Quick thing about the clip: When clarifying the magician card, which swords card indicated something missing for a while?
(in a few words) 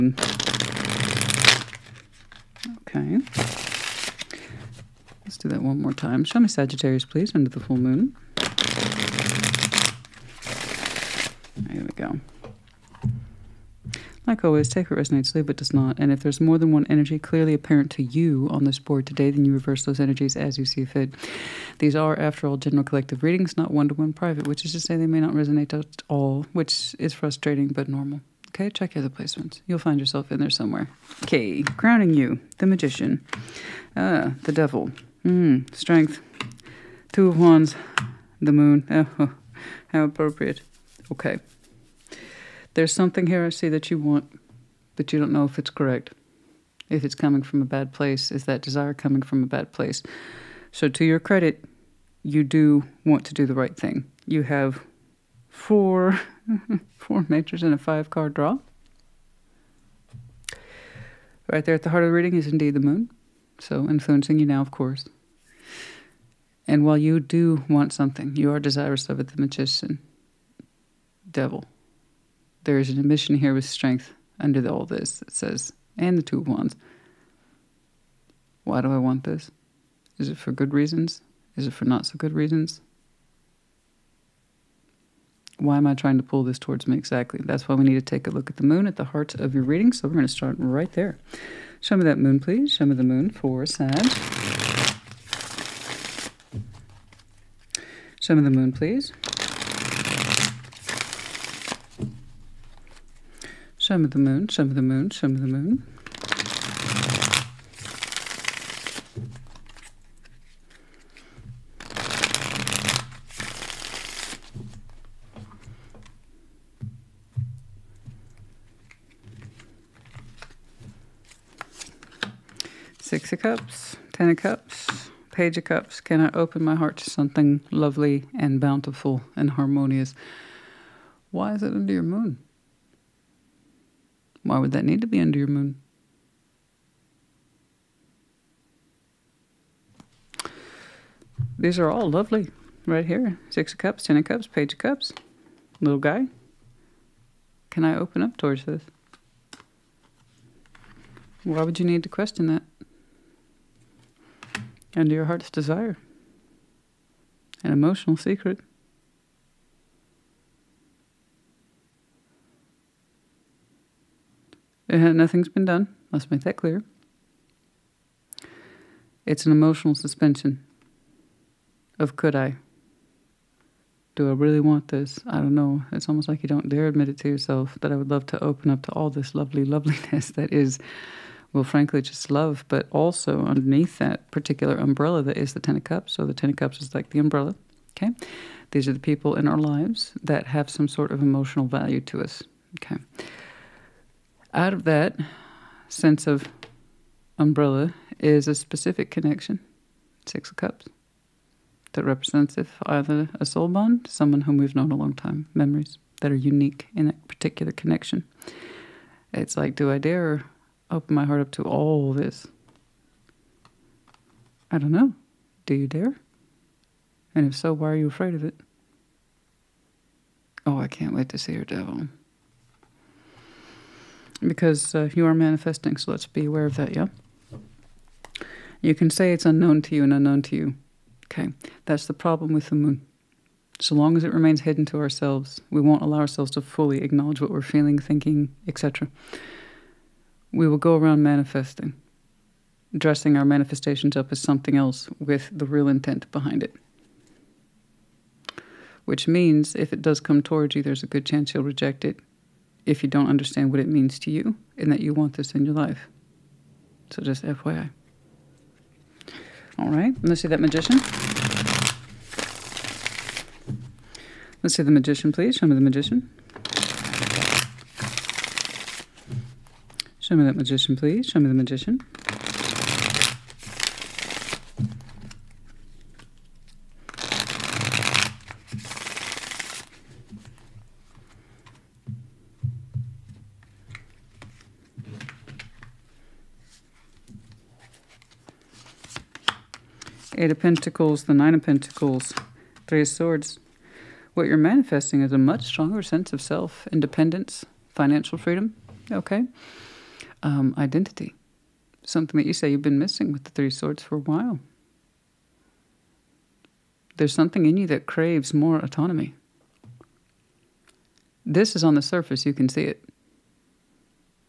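Three of Swords.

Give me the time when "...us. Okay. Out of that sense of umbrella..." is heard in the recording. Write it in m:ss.
3:12.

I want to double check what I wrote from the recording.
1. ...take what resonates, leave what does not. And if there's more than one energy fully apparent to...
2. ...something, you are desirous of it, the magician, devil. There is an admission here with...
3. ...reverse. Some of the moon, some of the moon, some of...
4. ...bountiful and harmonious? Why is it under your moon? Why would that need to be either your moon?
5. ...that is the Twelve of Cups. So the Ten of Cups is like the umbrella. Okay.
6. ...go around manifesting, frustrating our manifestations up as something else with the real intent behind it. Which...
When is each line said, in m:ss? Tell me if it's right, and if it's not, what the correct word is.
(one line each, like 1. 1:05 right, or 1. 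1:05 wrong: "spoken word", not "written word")
1. 0:14 wrong: "clearly", not "fully"
2. 1:07 right
3. 1:38 wrong: "please", not "reverse"
4. 2:08 wrong: "under", not "either"
5. 3:05 wrong: "Ten", not "Twelve"
6. 4:00 wrong: "dressing", not "frustrating".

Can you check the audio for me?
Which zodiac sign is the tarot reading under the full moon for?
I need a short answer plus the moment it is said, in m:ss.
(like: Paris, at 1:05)
Sagittarius, at 0:06.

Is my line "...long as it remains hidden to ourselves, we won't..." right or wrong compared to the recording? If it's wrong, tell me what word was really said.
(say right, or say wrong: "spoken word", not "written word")
right.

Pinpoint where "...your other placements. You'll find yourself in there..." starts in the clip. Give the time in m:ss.
0:28.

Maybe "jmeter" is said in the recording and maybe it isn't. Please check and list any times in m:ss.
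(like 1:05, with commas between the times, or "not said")
not said.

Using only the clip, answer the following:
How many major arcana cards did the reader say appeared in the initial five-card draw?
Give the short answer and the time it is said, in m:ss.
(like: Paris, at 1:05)
4, at 0:56.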